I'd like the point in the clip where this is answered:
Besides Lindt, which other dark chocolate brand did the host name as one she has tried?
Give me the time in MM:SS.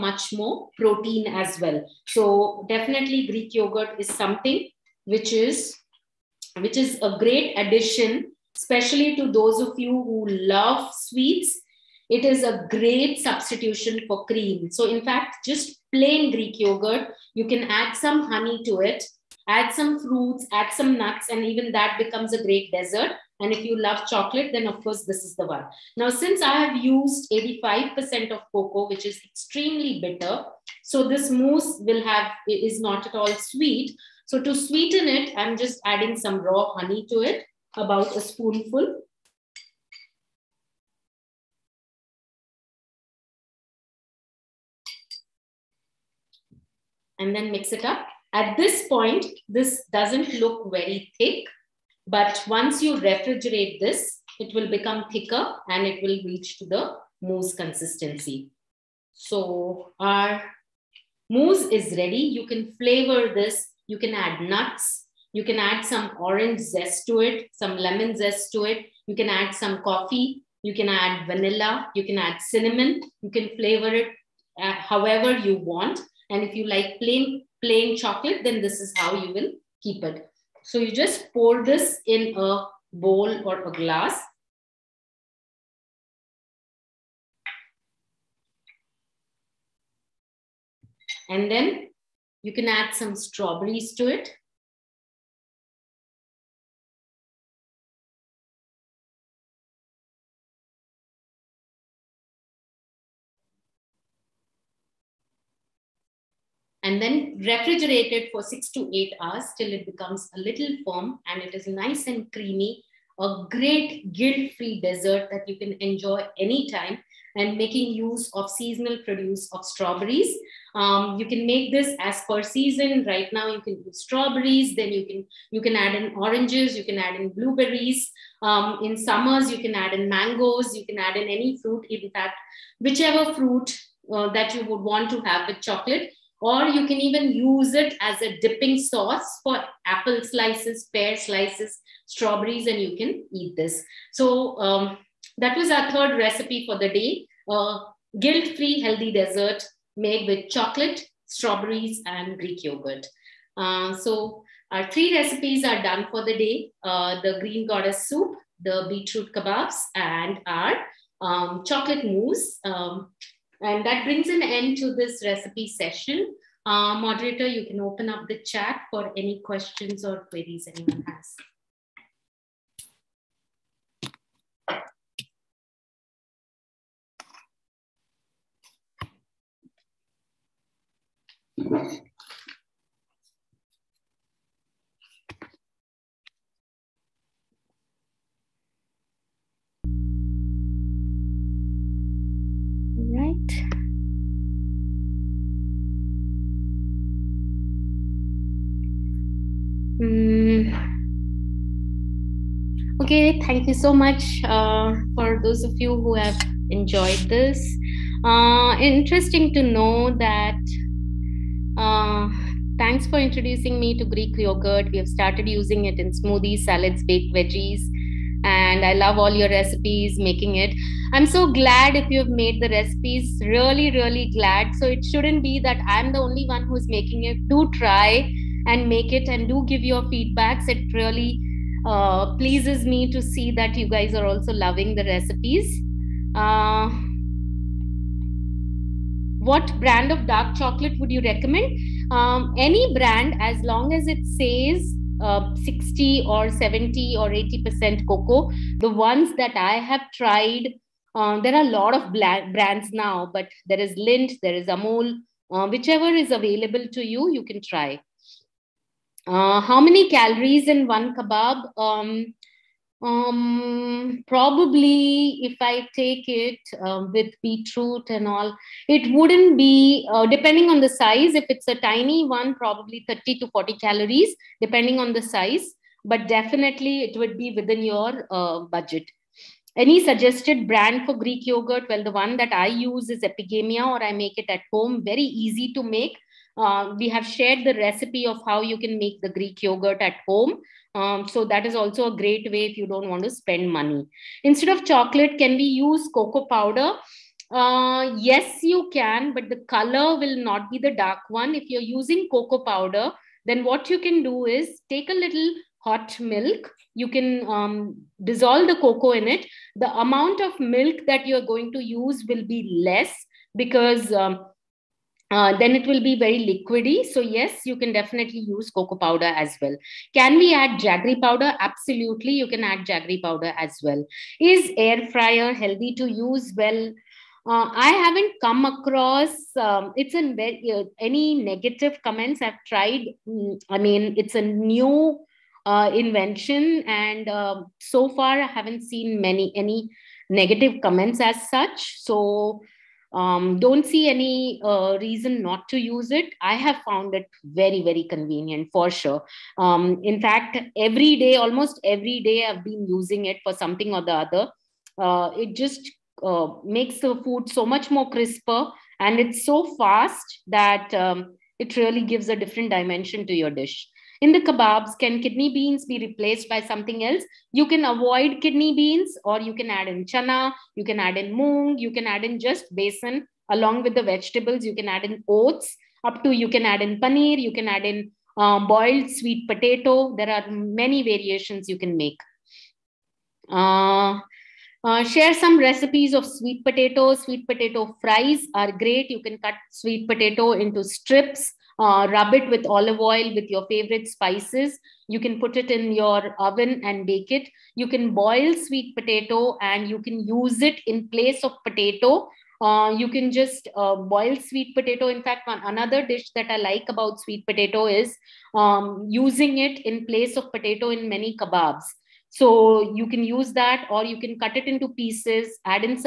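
04:14.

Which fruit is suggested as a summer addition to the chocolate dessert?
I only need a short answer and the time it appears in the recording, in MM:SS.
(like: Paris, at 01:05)
Mangoes, at 02:10.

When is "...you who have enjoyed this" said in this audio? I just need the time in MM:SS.
03:25.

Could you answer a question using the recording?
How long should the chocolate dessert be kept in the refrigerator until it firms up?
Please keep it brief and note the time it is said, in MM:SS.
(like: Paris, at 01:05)
6 to 8 hours, at 01:48.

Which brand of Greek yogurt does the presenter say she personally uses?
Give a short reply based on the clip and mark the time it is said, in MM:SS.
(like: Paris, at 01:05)
Epigamia, at 04:43.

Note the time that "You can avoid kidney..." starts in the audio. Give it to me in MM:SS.
06:07.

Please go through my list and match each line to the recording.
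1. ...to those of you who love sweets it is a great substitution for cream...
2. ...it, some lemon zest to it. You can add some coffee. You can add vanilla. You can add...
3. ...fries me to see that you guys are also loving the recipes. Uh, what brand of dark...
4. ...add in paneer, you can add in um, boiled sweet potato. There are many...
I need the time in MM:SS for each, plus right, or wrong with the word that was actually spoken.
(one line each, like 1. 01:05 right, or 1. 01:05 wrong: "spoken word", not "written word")
1. 00:09 right
2. 01:07 right
3. 03:52 wrong: "pleases", not "fries"
4. 06:16 right.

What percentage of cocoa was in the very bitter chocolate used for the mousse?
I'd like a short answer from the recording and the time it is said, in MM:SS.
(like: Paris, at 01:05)
85%, at 00:27.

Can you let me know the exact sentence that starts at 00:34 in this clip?
So to sweeten it, I'm just adding some raw honey to it, about a spoonful.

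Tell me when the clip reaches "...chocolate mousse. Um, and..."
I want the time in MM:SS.
02:41.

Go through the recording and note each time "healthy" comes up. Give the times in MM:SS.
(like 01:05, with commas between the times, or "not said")
02:28, 05:25.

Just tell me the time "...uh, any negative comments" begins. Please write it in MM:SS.
05:30.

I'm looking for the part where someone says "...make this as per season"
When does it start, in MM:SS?
02:01.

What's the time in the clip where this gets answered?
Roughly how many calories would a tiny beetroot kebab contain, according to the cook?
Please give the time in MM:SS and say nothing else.
04:33.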